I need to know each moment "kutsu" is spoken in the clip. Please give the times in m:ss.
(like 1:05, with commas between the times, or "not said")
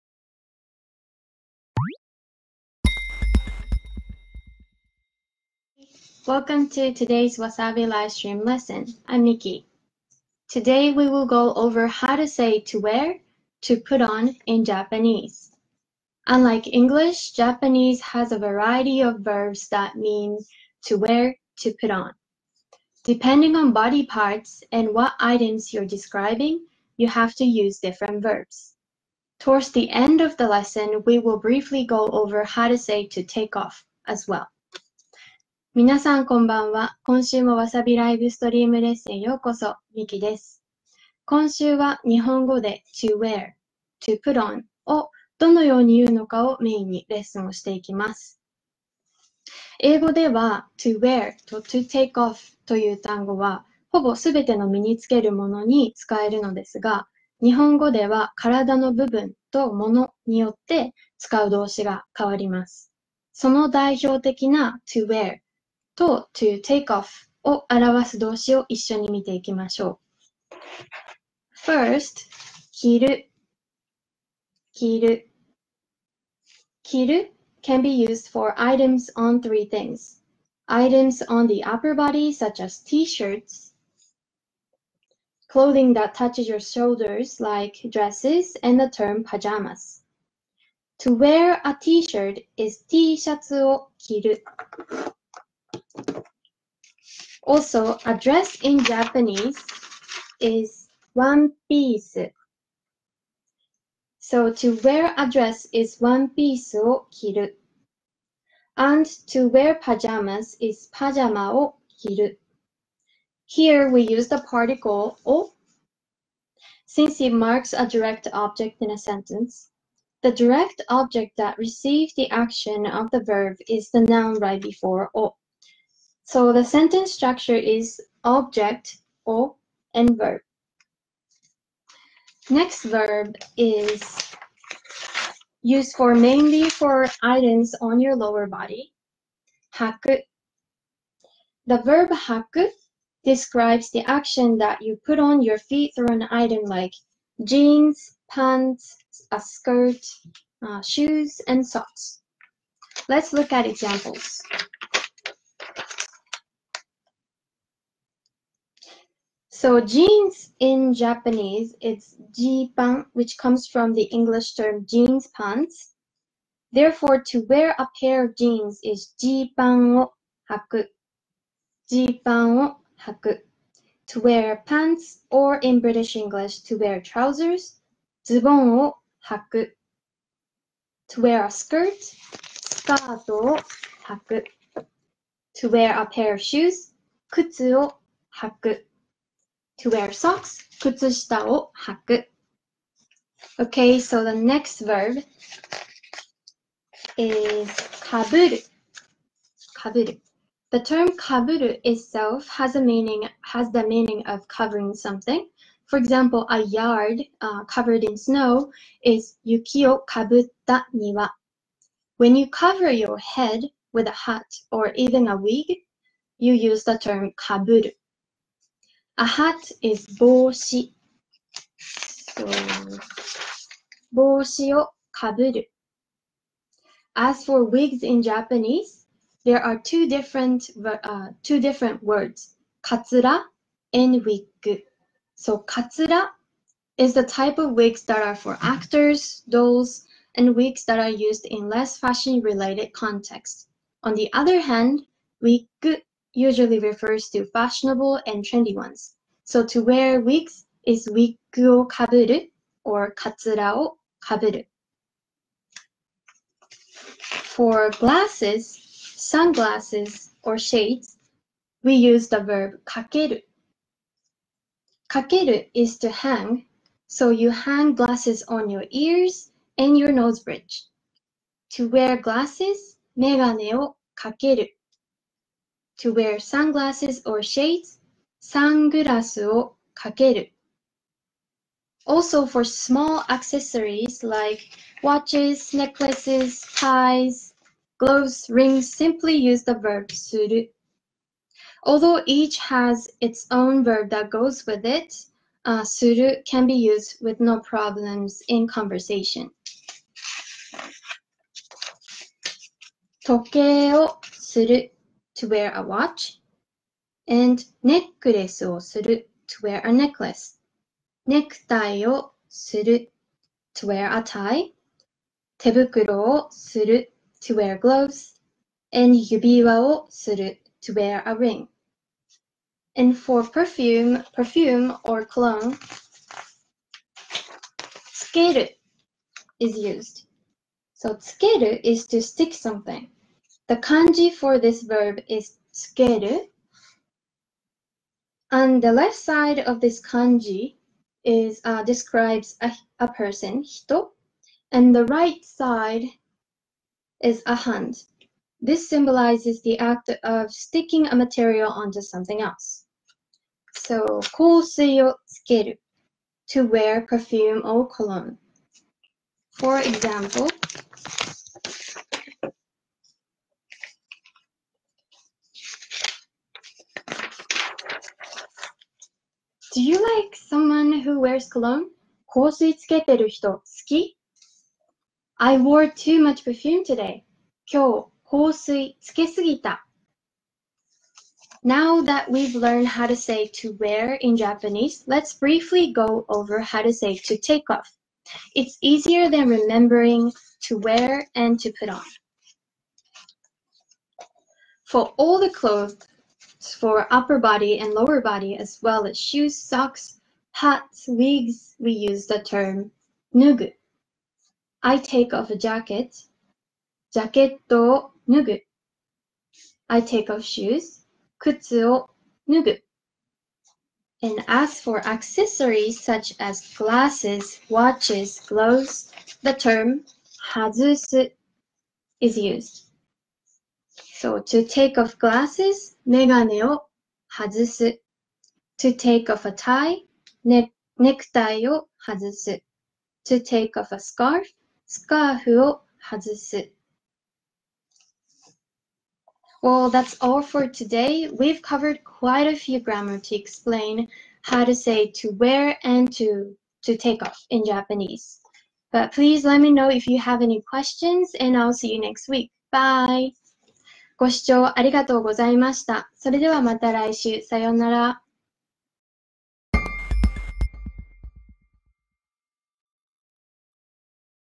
3:07, 6:51.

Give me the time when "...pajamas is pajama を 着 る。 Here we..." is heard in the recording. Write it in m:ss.
1:49.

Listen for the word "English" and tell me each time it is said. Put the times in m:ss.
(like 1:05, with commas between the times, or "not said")
0:16, 2:44, 2:56.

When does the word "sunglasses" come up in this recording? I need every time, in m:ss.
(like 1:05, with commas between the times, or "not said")
4:19, 4:36.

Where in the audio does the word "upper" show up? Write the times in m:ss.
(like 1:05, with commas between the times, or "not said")
1:21, 6:37.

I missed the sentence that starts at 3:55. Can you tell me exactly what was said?
So katsura is the type of wigs that are for actors, dolls, and wigs that are used in less fashion related contexts.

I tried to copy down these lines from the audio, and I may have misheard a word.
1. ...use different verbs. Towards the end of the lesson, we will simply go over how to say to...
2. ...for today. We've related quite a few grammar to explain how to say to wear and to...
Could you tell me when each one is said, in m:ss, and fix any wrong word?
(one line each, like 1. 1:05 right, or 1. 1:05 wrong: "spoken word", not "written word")
1. 0:27 wrong: "briefly", not "simply"
2. 7:20 wrong: "covered", not "related".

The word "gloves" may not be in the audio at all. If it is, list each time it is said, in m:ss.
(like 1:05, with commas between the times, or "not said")
4:47, 5:17, 6:58.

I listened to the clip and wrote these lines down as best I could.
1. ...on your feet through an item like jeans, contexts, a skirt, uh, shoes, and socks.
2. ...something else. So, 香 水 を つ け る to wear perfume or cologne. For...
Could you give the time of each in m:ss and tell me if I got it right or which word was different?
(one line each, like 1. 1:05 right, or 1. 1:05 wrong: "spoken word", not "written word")
1. 2:25 wrong: "pants", not "contexts"
2. 5:52 right.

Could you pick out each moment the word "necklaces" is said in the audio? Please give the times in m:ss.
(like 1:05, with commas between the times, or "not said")
4:45, 5:09.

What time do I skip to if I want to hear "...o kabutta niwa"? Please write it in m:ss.
3:29.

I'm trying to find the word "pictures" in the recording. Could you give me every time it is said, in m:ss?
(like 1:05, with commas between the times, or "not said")
not said.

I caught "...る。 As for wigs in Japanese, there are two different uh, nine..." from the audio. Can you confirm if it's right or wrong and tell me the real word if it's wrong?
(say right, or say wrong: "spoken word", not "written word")
wrong: "two", not "nine".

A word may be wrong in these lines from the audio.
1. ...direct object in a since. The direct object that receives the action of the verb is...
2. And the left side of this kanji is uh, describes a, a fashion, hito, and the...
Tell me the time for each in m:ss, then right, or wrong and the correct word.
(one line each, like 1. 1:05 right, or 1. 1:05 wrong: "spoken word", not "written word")
1. 1:57 wrong: "sentence", not "since"
2. 5:38 wrong: "person", not "fashion".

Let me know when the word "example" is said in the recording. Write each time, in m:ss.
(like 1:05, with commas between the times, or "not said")
2:33, 3:25, 5:59.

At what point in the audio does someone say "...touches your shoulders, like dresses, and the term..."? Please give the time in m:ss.
1:26.